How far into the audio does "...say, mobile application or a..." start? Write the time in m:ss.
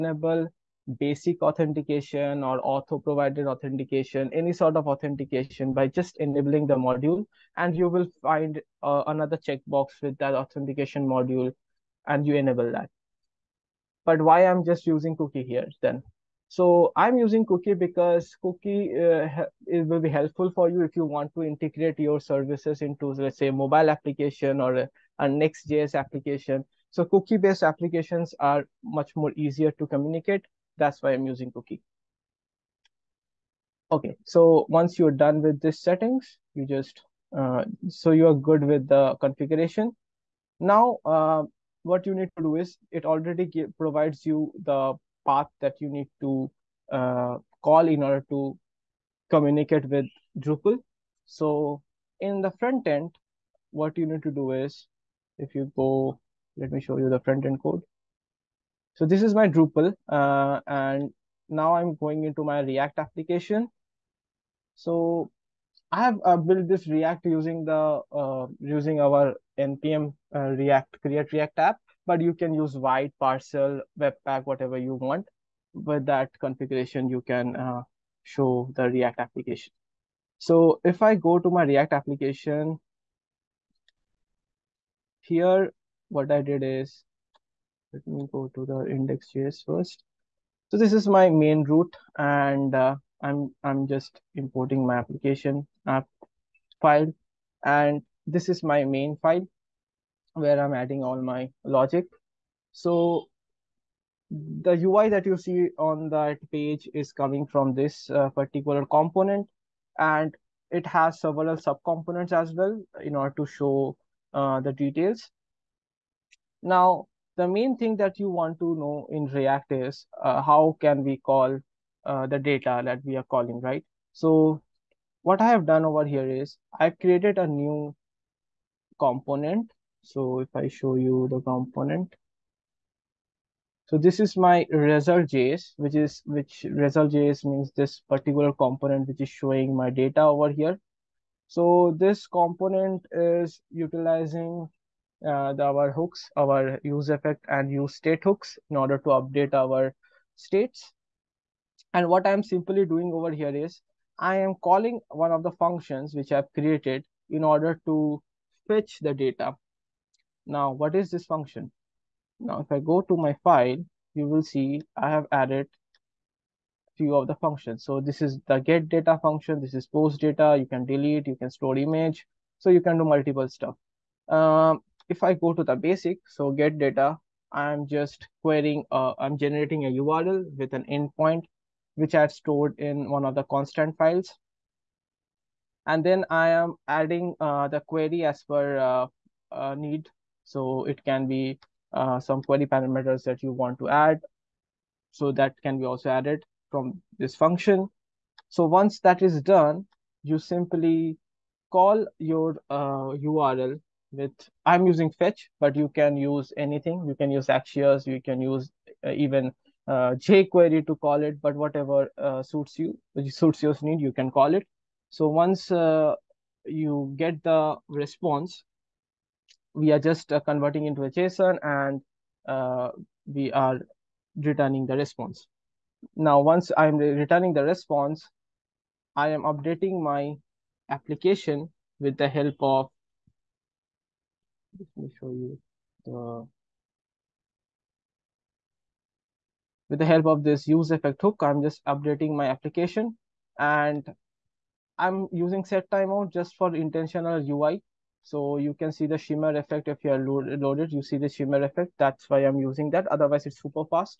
0:23.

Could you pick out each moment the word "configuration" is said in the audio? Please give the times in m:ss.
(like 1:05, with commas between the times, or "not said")
0:39, 1:16.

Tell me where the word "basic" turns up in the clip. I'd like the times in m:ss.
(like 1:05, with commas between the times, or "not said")
0:00, 2:55.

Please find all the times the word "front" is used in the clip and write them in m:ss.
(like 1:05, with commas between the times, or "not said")
0:52, 0:57.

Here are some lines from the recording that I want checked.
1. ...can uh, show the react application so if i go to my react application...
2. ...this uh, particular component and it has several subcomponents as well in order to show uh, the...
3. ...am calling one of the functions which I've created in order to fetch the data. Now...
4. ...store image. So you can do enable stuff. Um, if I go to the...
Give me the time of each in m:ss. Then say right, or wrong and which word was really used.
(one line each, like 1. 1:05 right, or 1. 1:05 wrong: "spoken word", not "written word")
1. 1:17 right
2. 1:47 right
3. 2:34 right
4. 2:51 wrong: "multiple", not "enable".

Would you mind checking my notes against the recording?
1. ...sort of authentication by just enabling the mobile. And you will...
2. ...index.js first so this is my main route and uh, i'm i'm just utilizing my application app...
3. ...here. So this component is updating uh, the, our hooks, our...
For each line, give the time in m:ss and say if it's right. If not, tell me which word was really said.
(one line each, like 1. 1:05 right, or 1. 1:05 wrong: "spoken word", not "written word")
1. 0:04 wrong: "module", not "mobile"
2. 1:28 wrong: "importing", not "utilizing"
3. 2:20 wrong: "utilizing", not "updating".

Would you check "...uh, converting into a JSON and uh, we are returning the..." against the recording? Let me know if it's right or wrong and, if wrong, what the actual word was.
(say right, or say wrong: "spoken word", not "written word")
right.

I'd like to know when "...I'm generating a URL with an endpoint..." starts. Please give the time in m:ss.
2:59.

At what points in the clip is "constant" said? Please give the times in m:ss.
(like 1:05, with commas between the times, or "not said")
3:03.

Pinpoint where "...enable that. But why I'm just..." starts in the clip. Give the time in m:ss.
0:12.